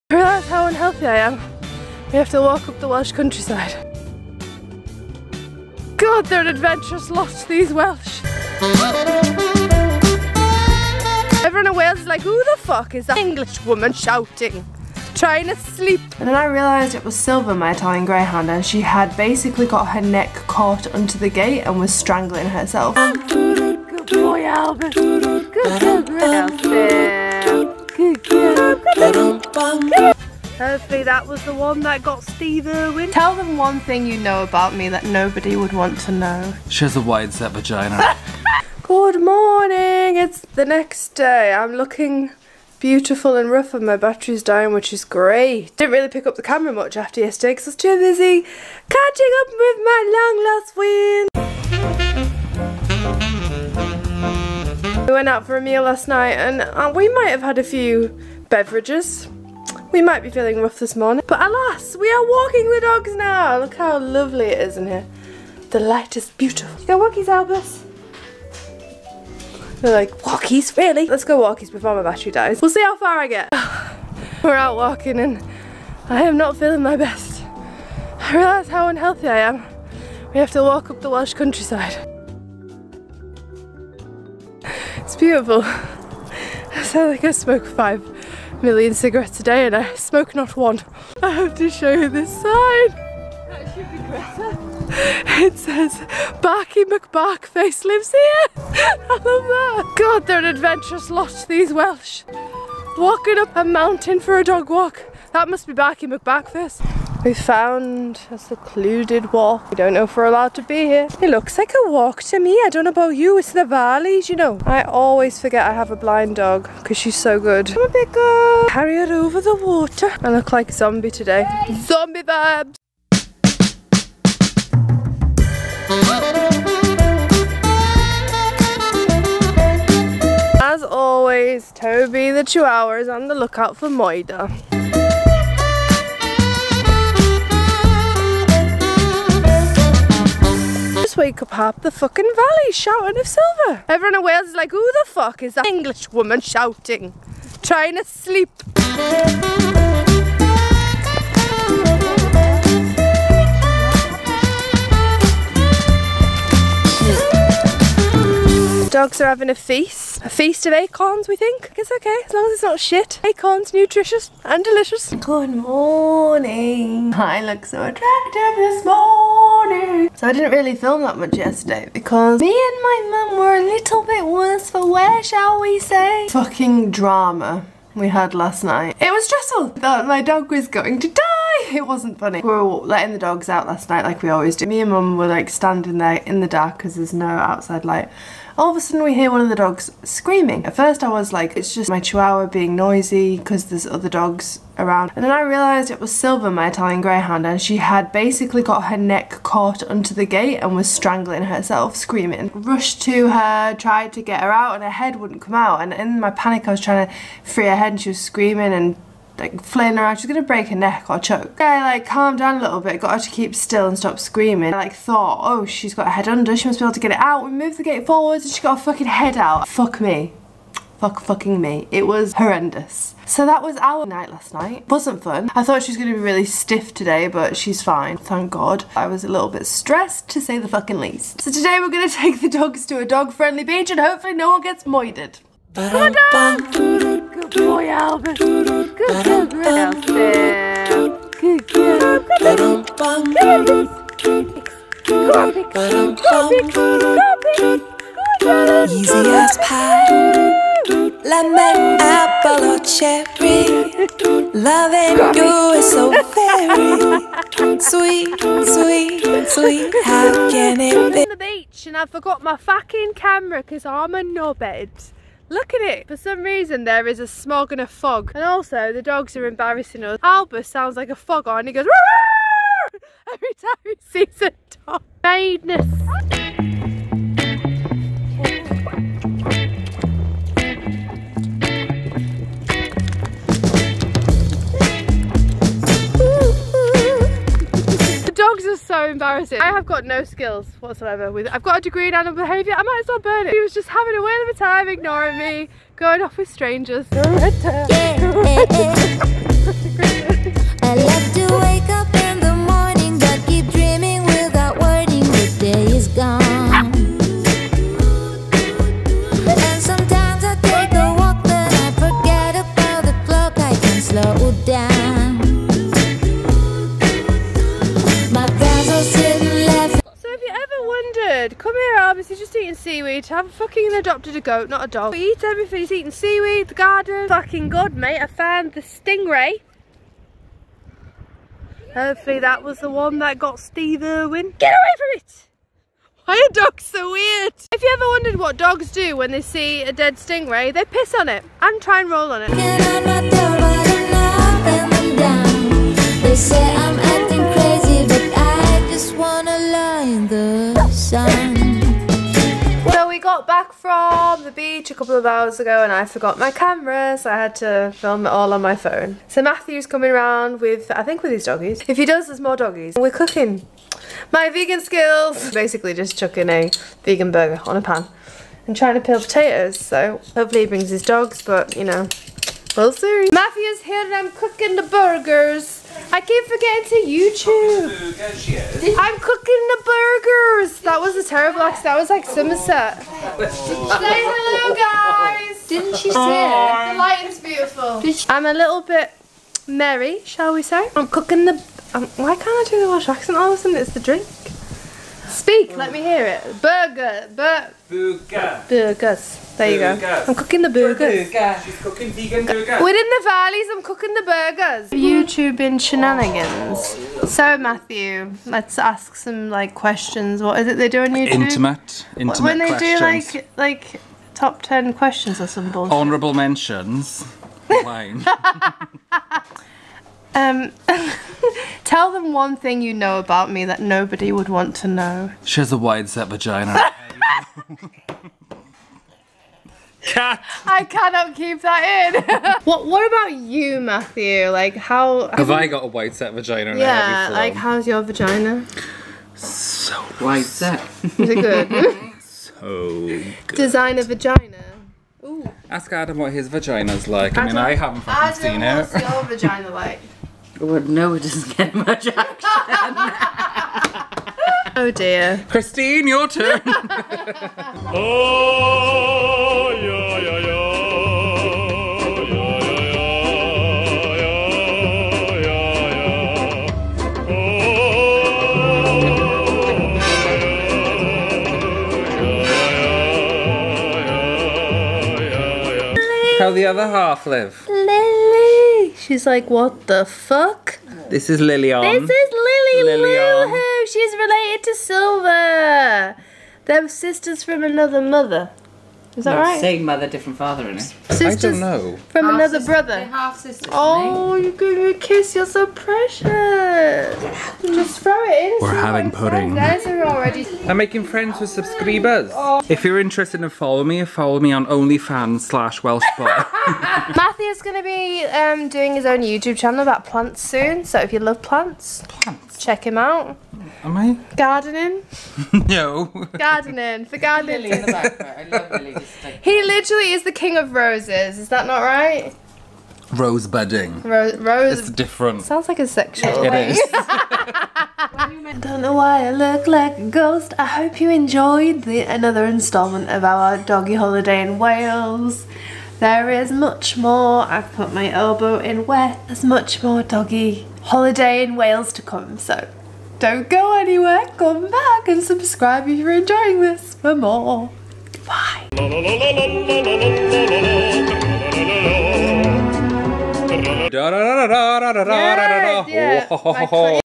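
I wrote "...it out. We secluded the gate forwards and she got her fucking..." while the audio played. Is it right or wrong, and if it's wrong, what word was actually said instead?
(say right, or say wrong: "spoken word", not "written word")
wrong: "moved", not "secluded".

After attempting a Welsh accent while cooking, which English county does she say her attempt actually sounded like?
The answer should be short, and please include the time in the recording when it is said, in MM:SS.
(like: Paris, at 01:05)
Somerset, at 06:22.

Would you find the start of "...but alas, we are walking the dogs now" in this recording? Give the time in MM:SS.
01:01.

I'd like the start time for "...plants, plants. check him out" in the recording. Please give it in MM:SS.
08:31.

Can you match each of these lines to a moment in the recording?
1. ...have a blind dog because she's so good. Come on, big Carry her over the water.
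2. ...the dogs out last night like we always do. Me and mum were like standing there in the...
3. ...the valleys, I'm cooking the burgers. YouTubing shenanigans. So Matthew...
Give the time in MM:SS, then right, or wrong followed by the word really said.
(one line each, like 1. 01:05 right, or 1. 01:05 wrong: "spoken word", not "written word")
1. 01:55 right
2. 03:03 right
3. 06:43 right.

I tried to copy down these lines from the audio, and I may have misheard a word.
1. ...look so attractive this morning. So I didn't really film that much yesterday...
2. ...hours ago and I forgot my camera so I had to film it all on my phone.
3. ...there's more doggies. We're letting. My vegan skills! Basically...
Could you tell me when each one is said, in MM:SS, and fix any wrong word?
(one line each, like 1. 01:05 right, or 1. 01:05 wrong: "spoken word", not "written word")
1. 02:47 right
2. 05:55 right
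3. 06:02 wrong: "cooking", not "letting".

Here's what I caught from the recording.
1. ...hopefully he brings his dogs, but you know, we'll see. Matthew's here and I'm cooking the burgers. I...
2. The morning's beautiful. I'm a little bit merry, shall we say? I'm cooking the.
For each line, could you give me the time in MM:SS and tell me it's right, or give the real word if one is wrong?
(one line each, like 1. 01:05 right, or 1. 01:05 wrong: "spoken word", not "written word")
1. 06:10 right
2. 06:26 wrong: "lighting", not "morning".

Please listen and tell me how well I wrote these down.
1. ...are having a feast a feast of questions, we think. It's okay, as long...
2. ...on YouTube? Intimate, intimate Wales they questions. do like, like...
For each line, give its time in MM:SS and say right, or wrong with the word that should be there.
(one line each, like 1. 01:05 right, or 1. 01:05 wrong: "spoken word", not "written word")
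1. 02:39 wrong: "acorns", not "questions"
2. 06:51 wrong: "When", not "Wales".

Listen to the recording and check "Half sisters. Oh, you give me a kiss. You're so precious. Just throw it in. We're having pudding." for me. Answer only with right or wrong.
right.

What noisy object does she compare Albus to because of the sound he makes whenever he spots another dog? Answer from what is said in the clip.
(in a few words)
A foghorn.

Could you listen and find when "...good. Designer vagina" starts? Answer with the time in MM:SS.
07:22.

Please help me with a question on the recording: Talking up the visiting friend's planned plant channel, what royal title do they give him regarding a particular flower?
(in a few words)
King of roses.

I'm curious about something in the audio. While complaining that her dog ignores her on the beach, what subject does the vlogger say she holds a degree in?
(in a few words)
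Animal behaviour.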